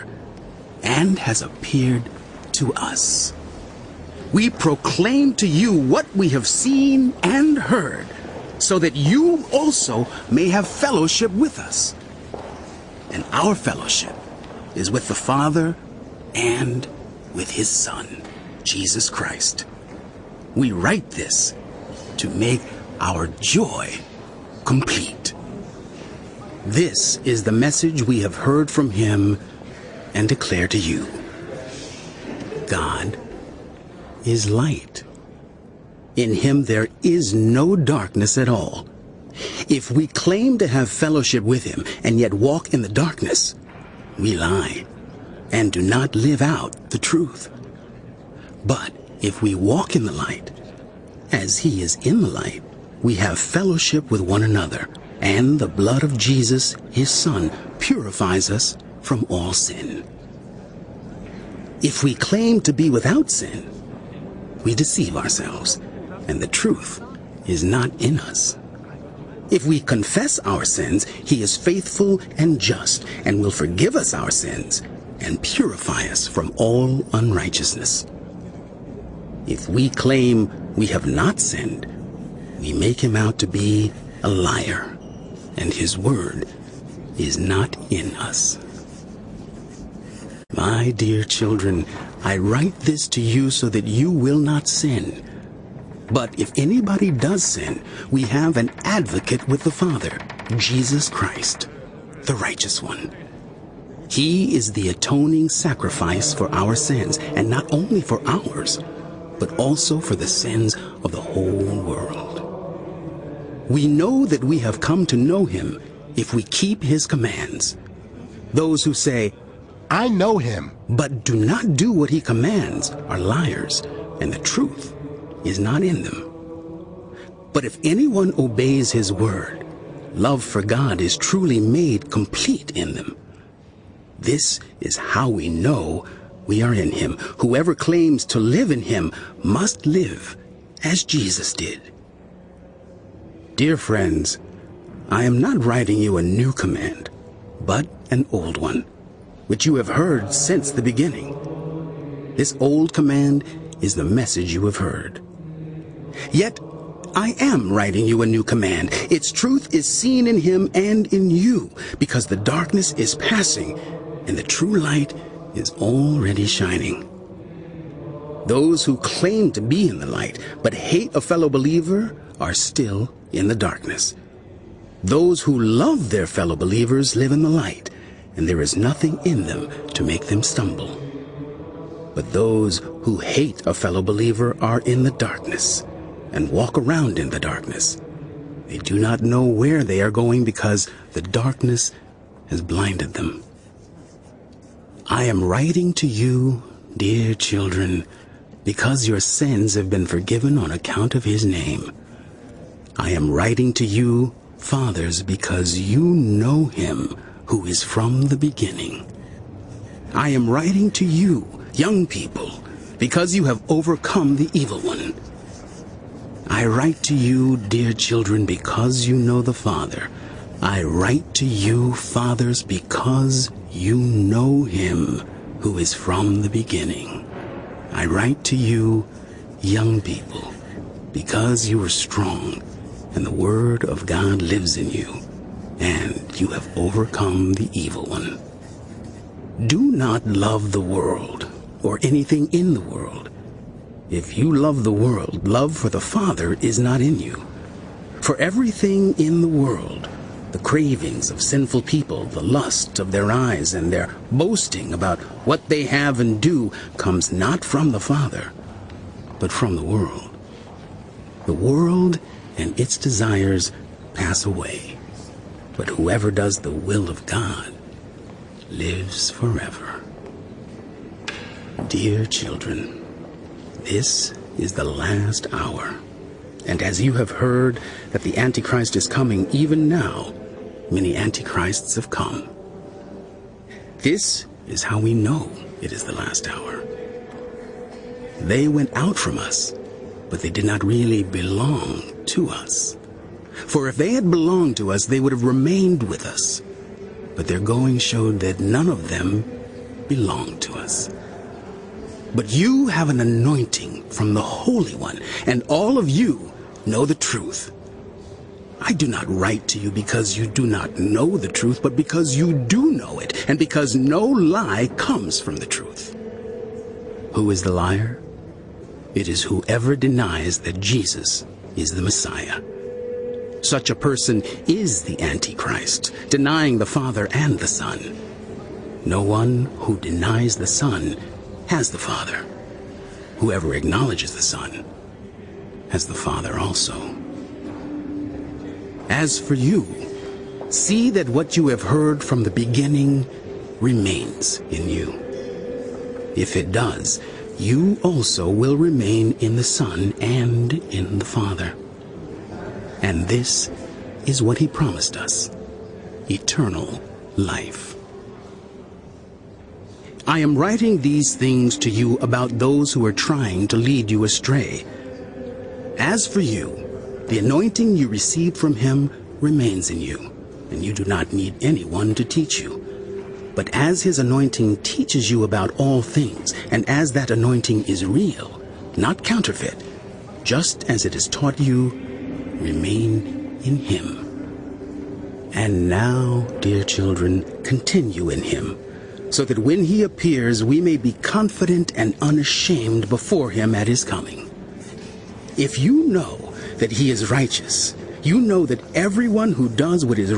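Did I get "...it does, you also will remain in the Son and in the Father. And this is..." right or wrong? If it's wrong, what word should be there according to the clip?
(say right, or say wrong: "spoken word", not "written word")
right.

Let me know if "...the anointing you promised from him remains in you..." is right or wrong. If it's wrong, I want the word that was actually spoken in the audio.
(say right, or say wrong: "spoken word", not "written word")
wrong: "received", not "promised".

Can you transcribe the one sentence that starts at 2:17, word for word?
Whoever claims to live in him must live as Jesus did.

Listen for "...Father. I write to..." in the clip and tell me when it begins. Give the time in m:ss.
3:39.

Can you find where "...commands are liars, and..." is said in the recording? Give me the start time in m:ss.
2:02.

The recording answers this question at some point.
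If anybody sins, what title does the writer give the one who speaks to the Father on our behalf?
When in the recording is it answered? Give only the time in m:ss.
1:38.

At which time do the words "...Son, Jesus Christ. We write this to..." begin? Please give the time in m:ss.
0:17.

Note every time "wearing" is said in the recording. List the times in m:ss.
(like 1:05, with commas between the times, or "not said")
not said.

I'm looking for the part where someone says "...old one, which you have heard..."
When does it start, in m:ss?
2:28.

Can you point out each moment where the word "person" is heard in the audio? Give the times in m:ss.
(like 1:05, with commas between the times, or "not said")
5:23.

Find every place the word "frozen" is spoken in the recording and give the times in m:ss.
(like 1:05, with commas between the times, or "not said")
not said.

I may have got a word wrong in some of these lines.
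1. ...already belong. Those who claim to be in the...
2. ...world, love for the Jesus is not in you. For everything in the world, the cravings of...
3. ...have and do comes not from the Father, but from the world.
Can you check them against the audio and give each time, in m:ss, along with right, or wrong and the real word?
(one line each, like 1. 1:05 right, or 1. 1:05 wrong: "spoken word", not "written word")
1. 2:45 wrong: "shining", not "belong"
2. 4:04 wrong: "Father", not "Jesus"
3. 4:15 right.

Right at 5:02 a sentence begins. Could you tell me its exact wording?
But you have an anointing from the Holy One, and all of you know the truth.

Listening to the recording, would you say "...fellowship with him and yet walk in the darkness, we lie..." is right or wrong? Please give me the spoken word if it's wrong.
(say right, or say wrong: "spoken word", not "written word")
right.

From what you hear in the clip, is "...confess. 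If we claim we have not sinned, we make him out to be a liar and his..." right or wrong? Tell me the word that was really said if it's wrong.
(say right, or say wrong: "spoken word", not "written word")
wrong: "unrighteousness", not "confess".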